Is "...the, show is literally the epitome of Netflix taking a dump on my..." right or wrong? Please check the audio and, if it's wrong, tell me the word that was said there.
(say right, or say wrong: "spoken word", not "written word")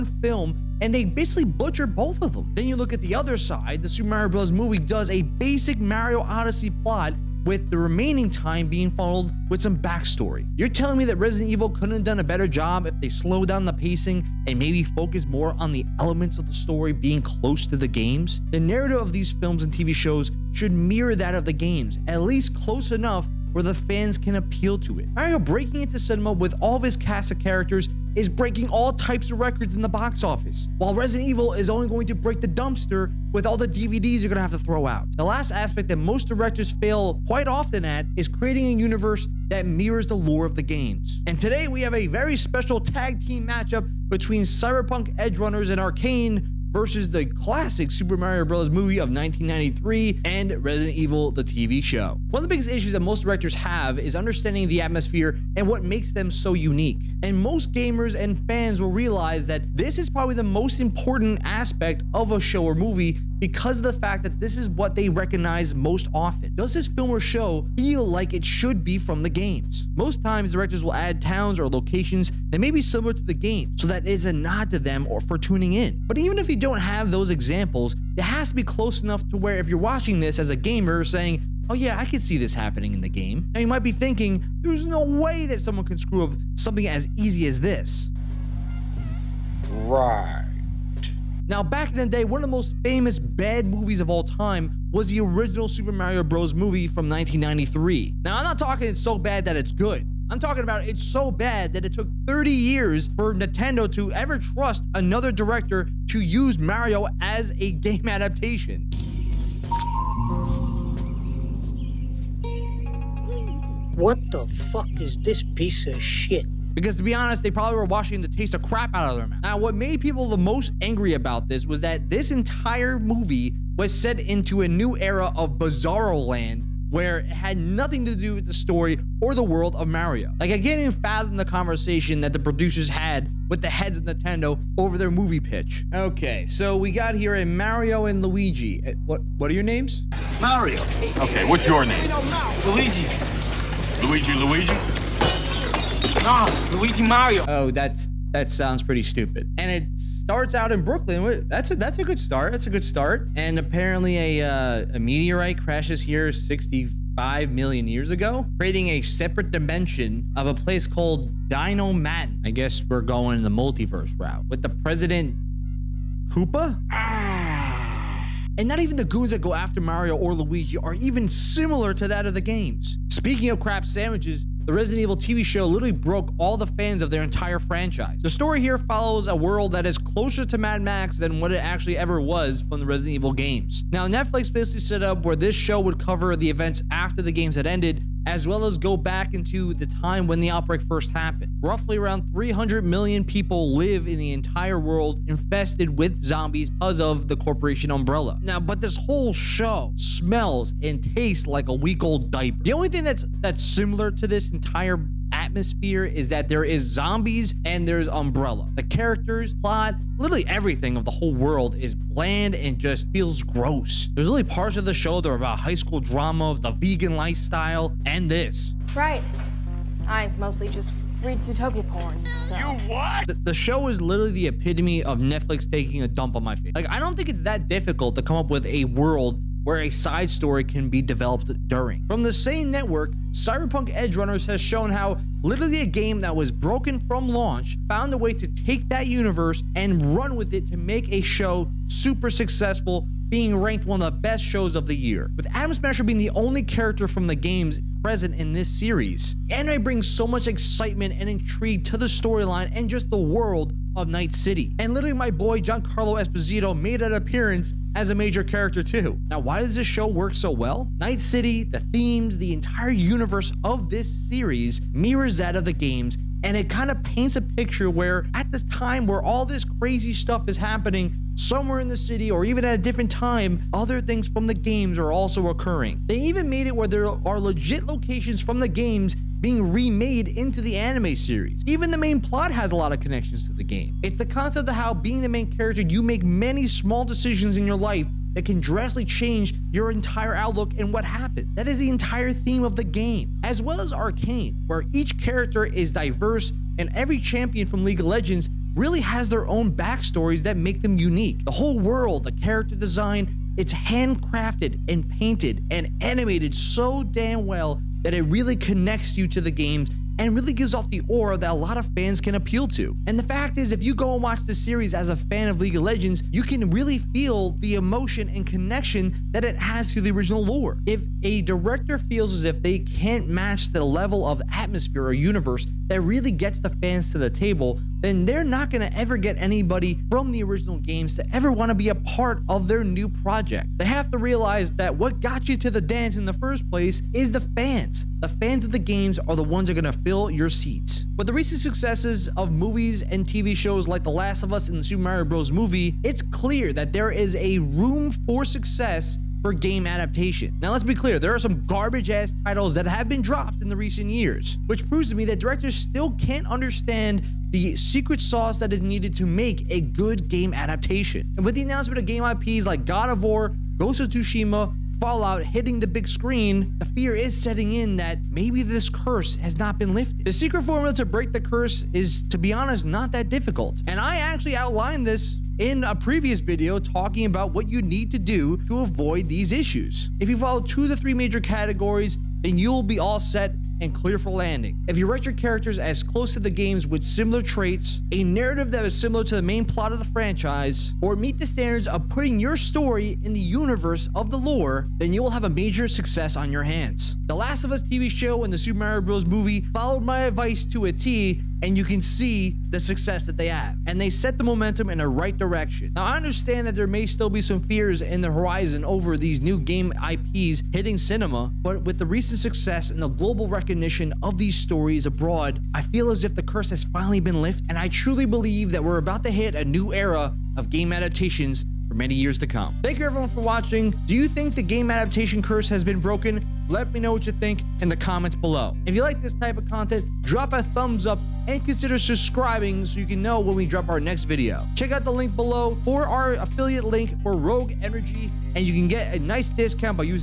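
right.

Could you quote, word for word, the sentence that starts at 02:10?
Like, I can't even fathom the conversation that the producers had with the heads of Nintendo over their movie pitch.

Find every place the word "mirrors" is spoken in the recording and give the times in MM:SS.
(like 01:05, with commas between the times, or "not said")
00:20, 00:39, 04:24.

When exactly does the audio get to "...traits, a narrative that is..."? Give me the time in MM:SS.
06:27.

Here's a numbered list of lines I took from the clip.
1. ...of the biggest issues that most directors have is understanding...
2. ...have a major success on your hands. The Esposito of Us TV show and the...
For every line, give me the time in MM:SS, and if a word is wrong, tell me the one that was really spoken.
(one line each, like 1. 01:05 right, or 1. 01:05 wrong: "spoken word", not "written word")
1. 00:52 right
2. 06:35 wrong: "Last", not "Esposito".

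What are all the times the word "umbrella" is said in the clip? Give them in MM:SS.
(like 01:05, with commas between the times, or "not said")
03:17, 03:28.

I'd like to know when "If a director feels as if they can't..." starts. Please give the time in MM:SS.
05:20.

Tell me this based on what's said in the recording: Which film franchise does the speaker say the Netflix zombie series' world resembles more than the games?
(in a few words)
Mad Max.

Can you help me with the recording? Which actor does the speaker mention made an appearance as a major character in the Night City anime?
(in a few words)
Giancarlo Esposito.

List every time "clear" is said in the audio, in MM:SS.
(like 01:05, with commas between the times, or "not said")
05:46, 05:50, 06:23.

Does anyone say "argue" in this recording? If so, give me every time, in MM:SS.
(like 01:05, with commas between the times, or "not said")
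not said.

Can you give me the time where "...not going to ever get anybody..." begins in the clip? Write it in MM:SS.
05:28.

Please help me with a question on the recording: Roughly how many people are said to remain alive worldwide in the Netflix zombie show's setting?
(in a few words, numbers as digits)
300 million.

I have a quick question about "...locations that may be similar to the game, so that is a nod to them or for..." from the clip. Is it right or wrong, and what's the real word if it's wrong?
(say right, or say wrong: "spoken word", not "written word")
right.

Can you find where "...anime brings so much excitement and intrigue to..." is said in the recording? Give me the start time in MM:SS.
04:09.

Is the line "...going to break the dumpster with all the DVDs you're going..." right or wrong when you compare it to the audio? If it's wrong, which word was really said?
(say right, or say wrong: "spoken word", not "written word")
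right.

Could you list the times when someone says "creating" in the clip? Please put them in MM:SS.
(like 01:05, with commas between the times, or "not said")
00:38, 02:38.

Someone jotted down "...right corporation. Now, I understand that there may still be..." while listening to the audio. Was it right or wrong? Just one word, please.
wrong.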